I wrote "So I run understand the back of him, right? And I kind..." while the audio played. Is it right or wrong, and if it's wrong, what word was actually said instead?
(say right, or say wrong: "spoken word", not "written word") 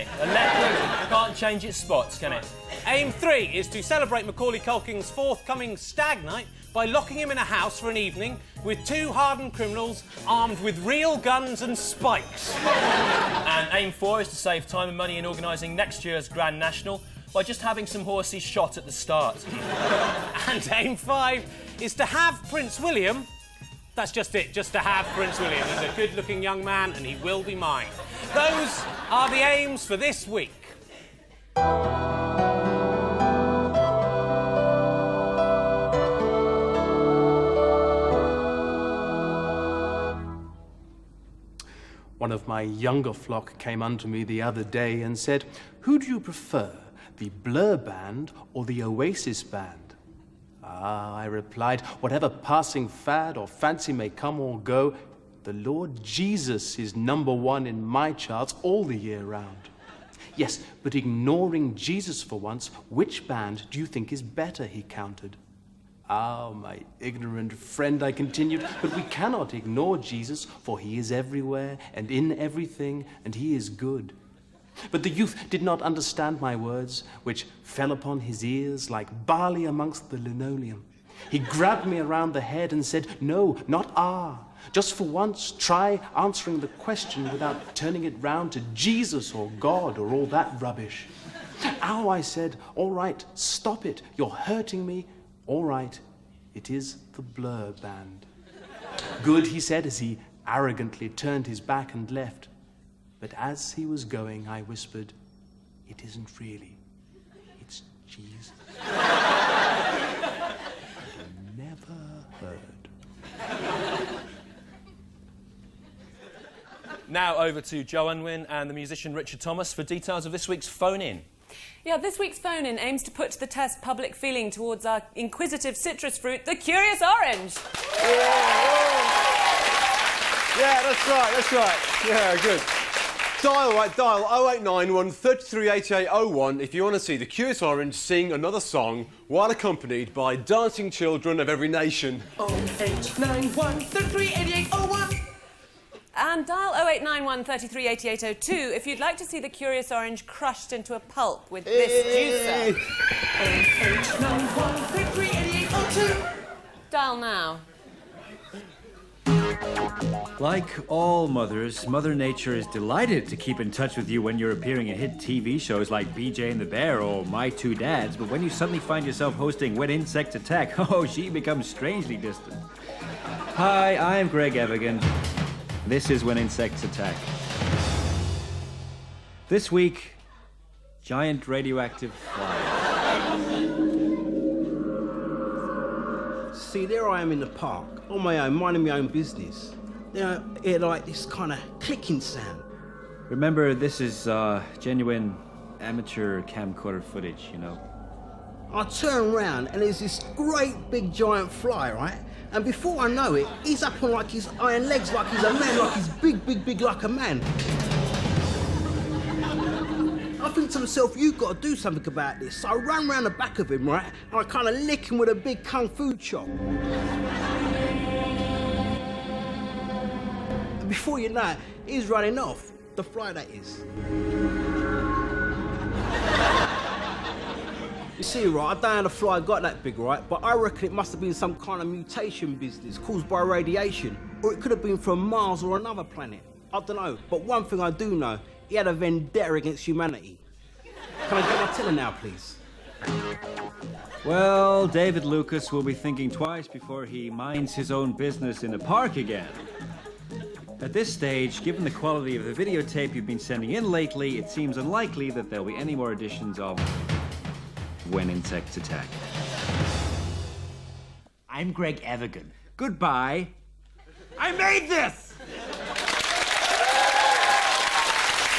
wrong: "round", not "understand".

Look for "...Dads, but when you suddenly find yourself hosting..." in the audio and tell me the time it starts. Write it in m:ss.
2:47.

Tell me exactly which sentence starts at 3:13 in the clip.
Remember, this is uh, genuine amateur camcorder footage, you know.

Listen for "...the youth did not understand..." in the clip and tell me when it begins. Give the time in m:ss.
1:15.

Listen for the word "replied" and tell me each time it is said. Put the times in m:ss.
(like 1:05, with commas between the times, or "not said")
0:51.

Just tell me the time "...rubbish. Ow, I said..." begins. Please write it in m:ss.
1:30.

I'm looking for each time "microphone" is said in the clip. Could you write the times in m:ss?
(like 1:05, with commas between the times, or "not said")
not said.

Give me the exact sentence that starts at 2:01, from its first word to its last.
Yeah, this week's phone in aims to put to the test public feeling towards our inquisitive citrus fruit, the curious orange.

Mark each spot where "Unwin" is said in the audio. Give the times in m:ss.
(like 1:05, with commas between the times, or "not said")
1:58.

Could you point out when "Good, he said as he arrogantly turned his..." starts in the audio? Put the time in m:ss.
1:39.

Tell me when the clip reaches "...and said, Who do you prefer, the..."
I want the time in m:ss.
0:45.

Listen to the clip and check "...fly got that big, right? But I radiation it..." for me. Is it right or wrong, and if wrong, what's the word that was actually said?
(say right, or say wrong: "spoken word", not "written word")
wrong: "reckon", not "radiation".